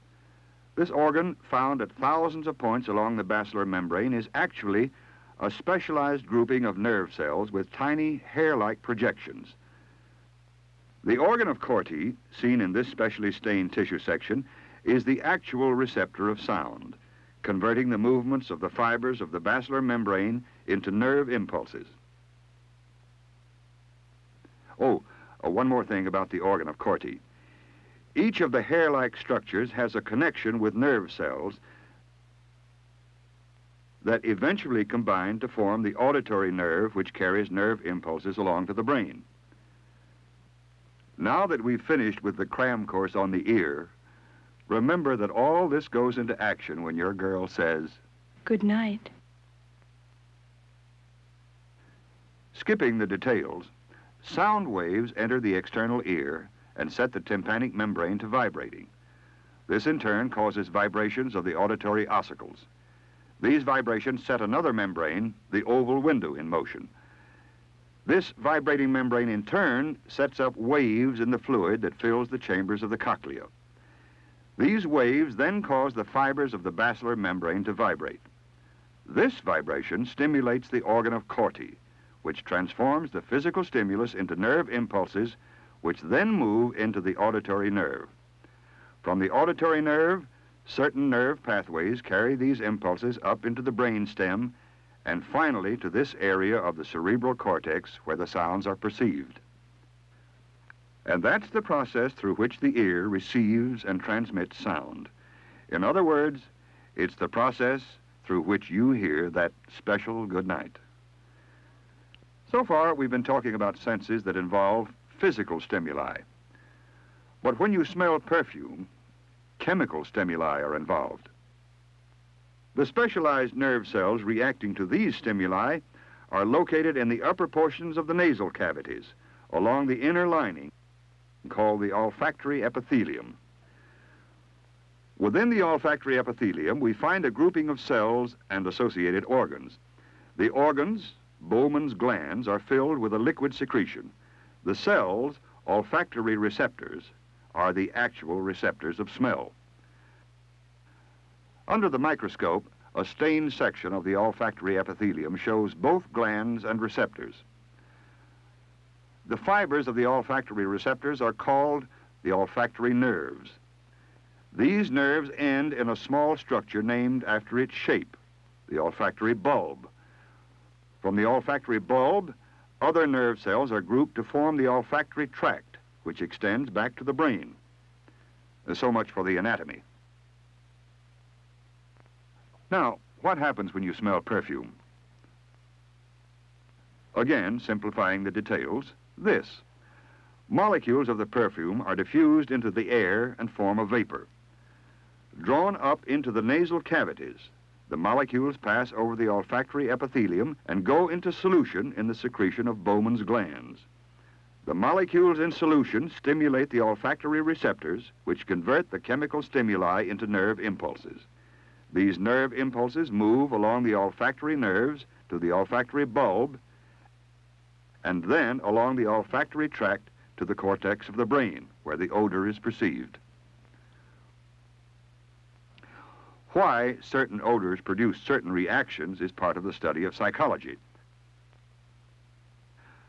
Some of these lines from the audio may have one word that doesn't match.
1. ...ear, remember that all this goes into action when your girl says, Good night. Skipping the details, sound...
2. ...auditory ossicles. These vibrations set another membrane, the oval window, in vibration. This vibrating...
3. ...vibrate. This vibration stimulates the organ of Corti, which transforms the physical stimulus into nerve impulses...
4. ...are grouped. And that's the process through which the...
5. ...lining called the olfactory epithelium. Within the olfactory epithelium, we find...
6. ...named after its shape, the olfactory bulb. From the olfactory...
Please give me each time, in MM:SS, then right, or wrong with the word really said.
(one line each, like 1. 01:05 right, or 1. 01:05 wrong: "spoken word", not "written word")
1. 00:43 right
2. 01:01 wrong: "motion", not "vibration"
3. 01:17 right
4. 01:38 wrong: "perceived", not "grouped"
5. 02:10 right
6. 02:46 right.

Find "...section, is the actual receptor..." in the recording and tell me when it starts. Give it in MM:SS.
00:13.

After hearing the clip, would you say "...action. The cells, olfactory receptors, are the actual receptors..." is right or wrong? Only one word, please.
wrong.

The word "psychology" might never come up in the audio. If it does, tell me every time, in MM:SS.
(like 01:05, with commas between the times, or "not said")
03:50.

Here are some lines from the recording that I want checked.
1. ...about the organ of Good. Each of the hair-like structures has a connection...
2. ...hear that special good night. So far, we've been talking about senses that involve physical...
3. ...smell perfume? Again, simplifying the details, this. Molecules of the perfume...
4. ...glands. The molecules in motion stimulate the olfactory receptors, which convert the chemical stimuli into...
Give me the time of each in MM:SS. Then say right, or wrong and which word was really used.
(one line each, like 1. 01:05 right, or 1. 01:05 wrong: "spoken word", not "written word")
1. 00:26 wrong: "Corti", not "Good"
2. 01:48 right
3. 03:03 right
4. 03:23 wrong: "solution", not "motion".